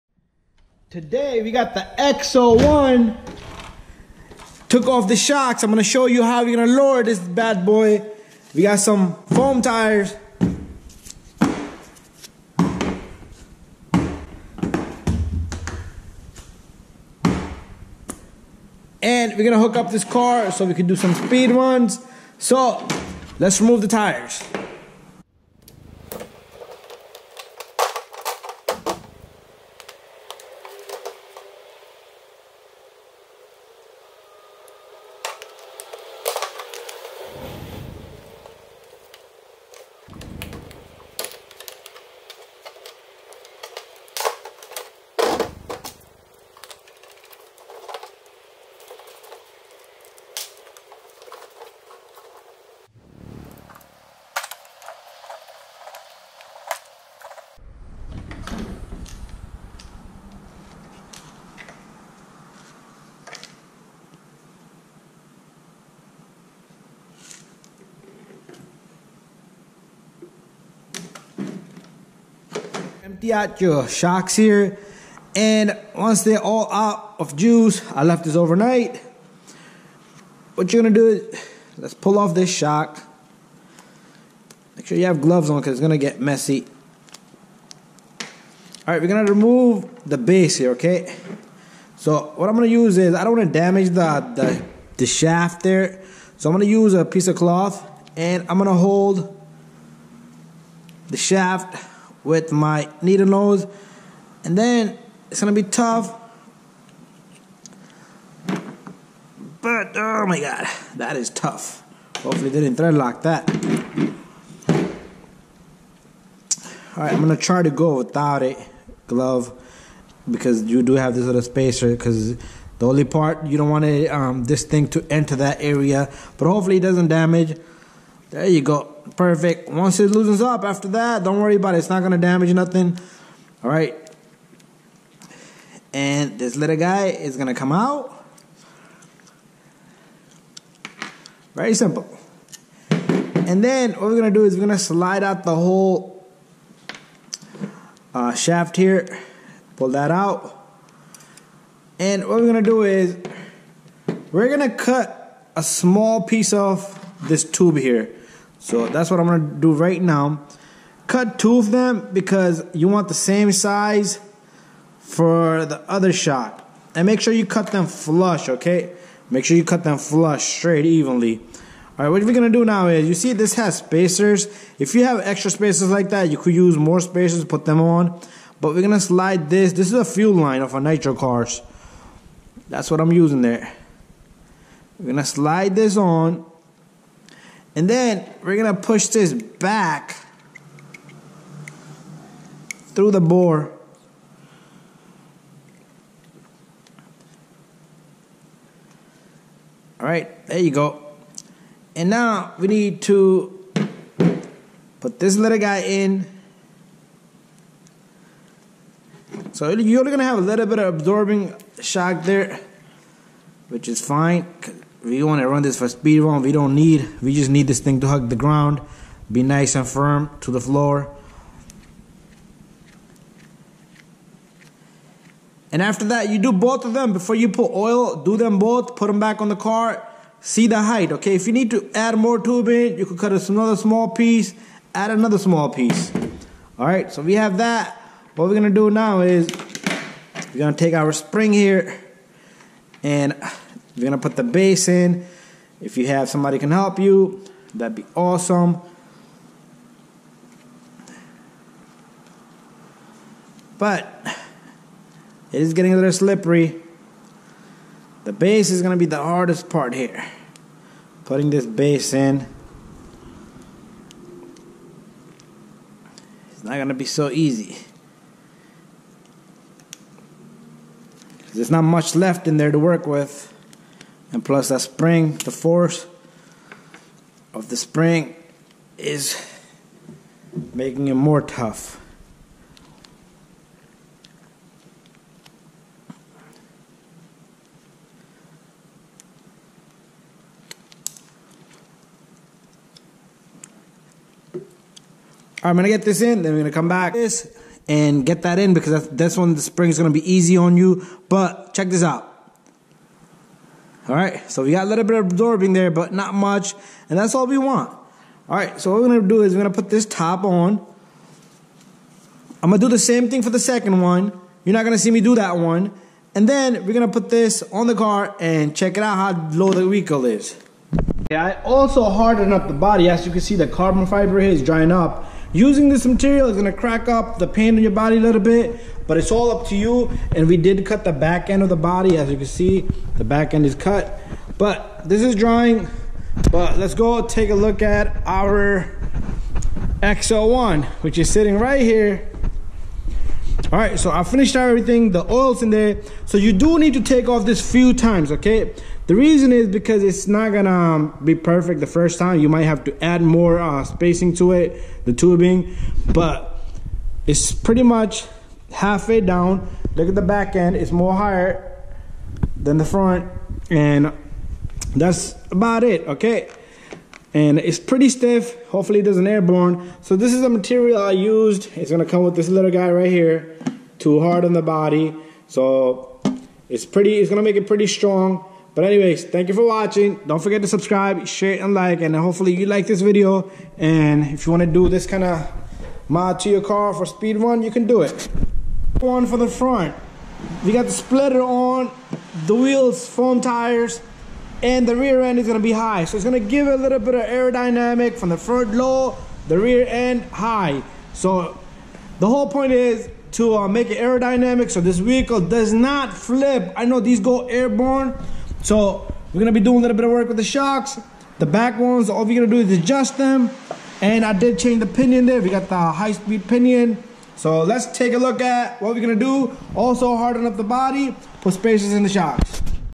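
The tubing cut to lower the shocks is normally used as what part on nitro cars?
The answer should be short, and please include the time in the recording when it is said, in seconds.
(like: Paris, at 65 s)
Fuel line, at 180 s.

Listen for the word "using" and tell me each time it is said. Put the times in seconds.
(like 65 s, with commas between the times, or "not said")
183 s, 325 s.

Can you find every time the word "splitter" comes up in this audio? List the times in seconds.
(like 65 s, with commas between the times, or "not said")
390 s.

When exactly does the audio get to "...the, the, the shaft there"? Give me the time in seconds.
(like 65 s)
93 s.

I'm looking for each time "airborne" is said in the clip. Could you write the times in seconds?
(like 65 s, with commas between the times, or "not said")
369 s, 407 s.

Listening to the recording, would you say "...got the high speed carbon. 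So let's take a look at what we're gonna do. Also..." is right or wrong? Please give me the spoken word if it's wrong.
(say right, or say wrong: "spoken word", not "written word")
wrong: "pinion", not "carbon".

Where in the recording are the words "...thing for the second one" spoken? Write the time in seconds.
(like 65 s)
313 s.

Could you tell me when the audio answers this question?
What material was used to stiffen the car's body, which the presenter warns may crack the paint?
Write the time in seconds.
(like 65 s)
323 s.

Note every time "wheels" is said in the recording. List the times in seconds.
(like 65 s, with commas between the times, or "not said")
392 s.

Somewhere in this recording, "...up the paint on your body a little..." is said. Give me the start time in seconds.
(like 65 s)
327 s.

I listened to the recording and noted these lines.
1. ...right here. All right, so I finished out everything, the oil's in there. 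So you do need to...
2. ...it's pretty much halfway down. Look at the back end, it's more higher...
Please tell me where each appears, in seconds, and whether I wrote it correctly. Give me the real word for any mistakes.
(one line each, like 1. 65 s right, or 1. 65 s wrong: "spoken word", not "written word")
1. 341 s right
2. 357 s right.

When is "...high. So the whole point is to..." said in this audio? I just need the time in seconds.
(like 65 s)
400 s.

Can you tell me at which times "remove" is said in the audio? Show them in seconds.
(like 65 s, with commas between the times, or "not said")
23 s, 89 s.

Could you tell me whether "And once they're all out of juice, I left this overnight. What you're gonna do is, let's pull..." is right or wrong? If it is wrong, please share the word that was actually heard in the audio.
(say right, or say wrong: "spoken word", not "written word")
right.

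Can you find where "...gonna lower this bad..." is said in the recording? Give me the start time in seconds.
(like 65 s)
6 s.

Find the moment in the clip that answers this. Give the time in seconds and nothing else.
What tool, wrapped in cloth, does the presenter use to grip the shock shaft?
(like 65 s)
103 s.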